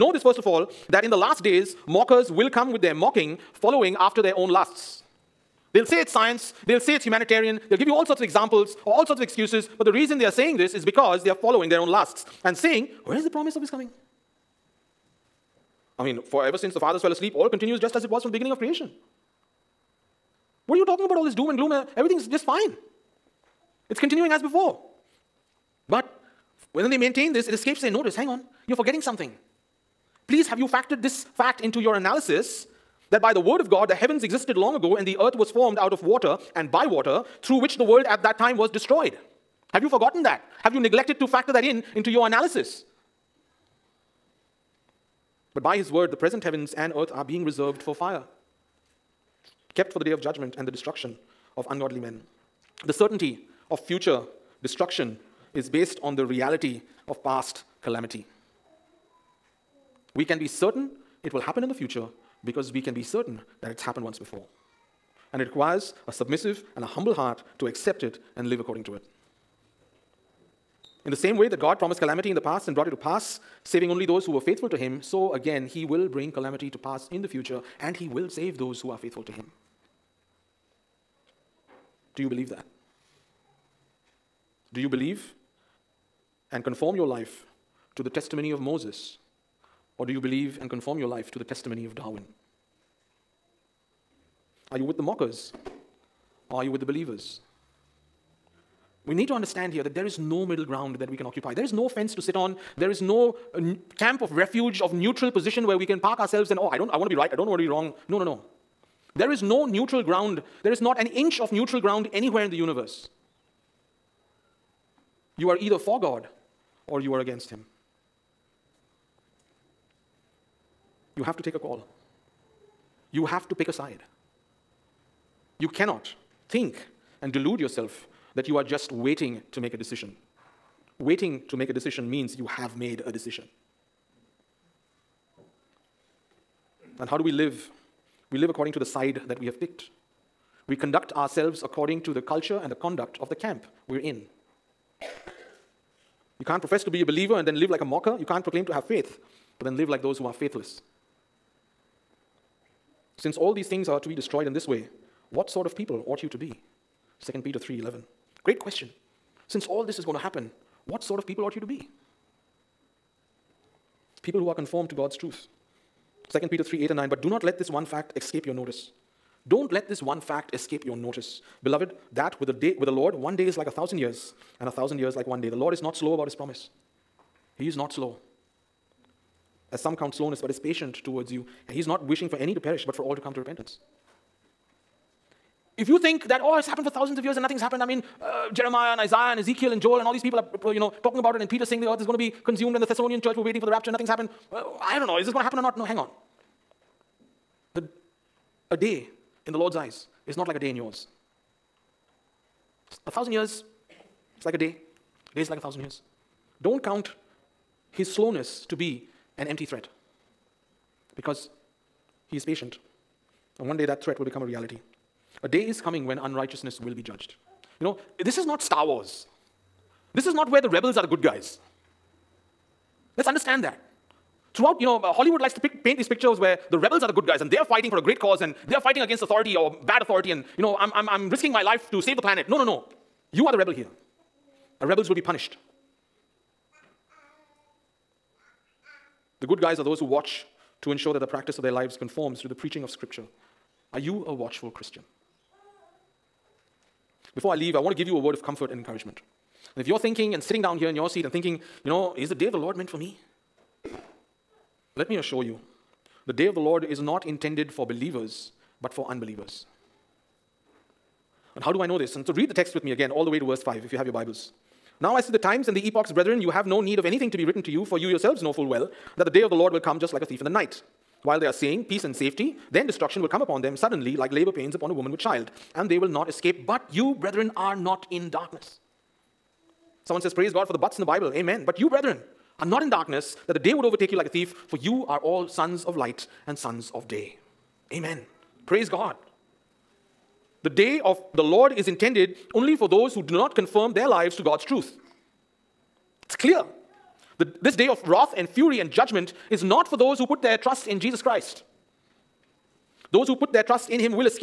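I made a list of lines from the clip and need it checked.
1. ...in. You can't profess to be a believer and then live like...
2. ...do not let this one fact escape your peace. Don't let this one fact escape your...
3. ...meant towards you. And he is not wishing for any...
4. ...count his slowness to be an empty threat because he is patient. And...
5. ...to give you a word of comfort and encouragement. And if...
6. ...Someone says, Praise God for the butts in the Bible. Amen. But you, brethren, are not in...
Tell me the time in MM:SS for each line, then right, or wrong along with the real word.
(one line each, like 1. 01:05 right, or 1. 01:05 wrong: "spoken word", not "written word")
1. 02:23 right
2. 02:47 wrong: "notice", not "peace"
3. 03:00 wrong: "patient", not "meant"
4. 03:26 right
5. 04:07 right
6. 04:40 right.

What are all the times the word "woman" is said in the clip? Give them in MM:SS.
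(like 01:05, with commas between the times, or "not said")
04:34.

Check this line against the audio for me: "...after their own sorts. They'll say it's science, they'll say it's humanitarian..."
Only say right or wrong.
wrong.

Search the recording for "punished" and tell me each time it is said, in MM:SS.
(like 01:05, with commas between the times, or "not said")
03:55.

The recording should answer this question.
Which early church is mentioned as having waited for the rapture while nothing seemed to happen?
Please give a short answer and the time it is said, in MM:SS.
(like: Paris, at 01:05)
Thessalonian church, at 03:12.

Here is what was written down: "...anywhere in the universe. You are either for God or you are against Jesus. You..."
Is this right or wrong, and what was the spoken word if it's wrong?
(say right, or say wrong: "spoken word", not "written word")
wrong: "Him", not "Jesus".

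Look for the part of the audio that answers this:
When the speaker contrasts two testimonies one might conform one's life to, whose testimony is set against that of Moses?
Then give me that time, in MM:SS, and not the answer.
01:31.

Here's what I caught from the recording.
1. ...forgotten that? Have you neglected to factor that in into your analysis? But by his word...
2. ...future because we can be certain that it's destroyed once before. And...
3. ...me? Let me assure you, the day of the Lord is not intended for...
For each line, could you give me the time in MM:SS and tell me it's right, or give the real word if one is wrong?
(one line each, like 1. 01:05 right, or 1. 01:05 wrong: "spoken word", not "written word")
1. 00:39 right
2. 01:01 wrong: "happened", not "destroyed"
3. 04:12 right.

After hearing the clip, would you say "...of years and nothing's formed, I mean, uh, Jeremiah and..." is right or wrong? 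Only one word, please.
wrong.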